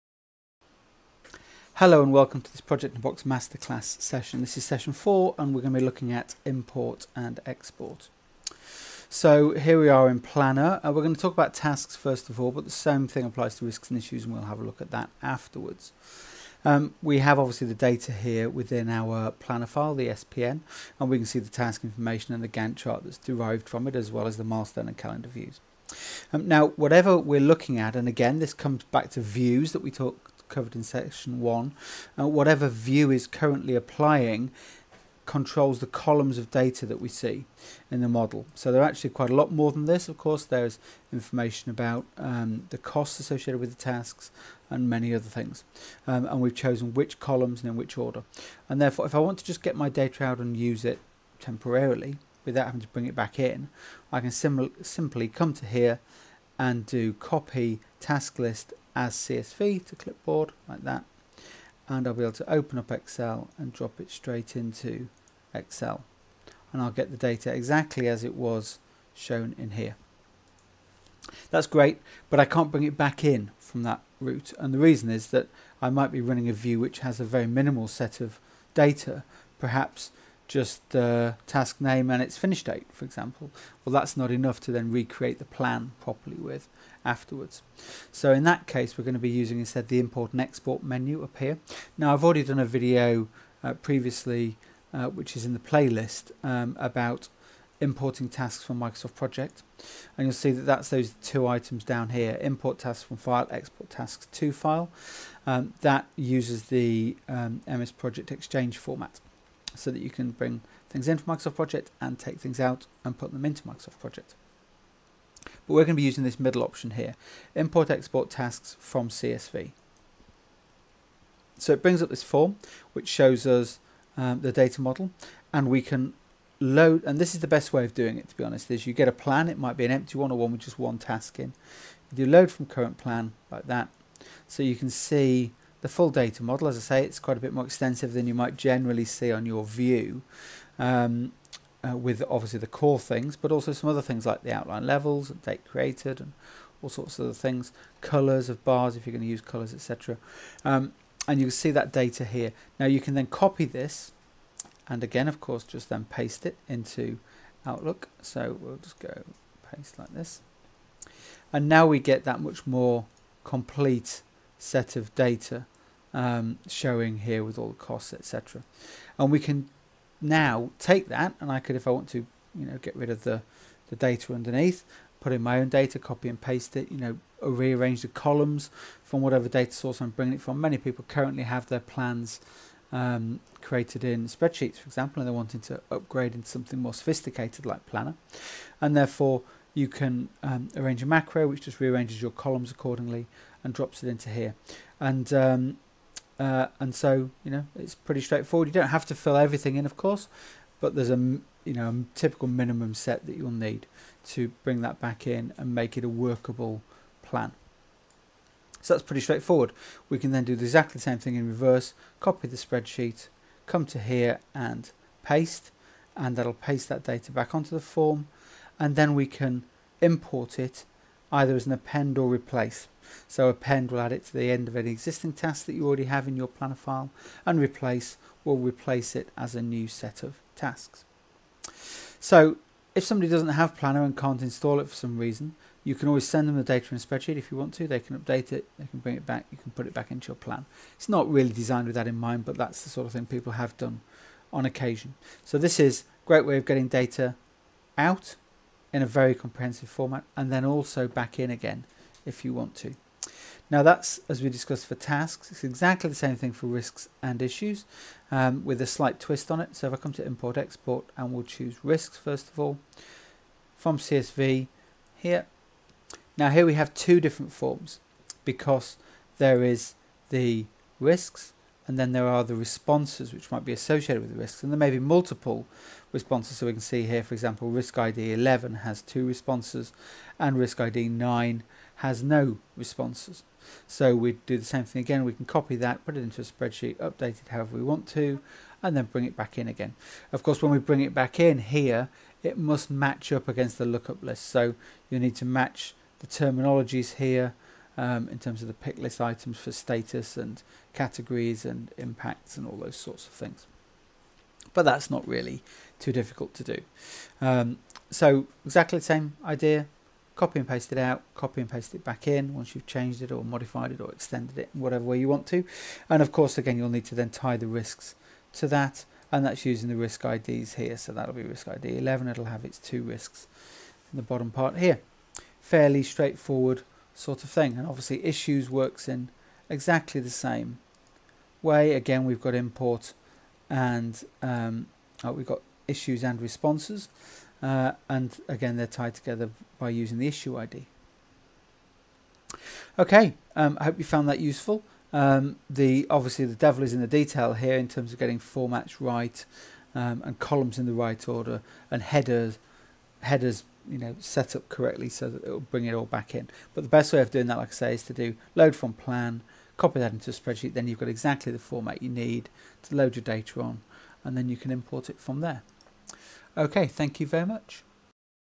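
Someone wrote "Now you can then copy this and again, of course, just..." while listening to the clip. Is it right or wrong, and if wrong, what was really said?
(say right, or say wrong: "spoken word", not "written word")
right.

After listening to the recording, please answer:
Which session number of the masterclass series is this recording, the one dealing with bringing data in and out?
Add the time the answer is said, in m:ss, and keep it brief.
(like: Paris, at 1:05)
4, at 0:04.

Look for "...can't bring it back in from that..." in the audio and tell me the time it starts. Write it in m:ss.
1:12.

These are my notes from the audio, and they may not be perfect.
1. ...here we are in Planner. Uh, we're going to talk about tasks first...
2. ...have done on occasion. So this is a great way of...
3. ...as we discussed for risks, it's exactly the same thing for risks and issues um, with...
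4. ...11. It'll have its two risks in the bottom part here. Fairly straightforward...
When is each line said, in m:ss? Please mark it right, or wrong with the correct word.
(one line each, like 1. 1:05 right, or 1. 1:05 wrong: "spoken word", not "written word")
1. 0:09 right
2. 4:03 right
3. 4:14 wrong: "tasks", not "risks"
4. 5:21 right.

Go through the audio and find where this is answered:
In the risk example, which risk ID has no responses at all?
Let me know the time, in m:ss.
4:41.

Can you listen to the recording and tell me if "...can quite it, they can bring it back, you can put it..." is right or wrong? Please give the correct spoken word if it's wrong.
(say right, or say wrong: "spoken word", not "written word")
wrong: "update", not "quite".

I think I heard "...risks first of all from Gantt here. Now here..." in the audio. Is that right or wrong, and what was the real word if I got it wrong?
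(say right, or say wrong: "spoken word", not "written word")
wrong: "CSV", not "Gantt".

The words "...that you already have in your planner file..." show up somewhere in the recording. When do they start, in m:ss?
3:45.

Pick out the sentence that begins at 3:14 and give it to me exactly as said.
And um, uh, and so, you know, it's pretty straightforward.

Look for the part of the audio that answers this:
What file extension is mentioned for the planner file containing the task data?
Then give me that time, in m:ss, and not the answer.
0:20.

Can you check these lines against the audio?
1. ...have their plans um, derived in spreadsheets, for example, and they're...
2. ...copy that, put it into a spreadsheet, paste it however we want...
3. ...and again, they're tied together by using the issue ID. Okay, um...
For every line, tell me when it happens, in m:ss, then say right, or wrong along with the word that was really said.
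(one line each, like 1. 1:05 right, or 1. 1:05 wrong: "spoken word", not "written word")
1. 3:01 wrong: "created", not "derived"
2. 4:45 wrong: "update", not "paste"
3. 5:38 right.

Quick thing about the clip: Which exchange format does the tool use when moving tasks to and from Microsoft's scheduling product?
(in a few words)
MS Project Exchange.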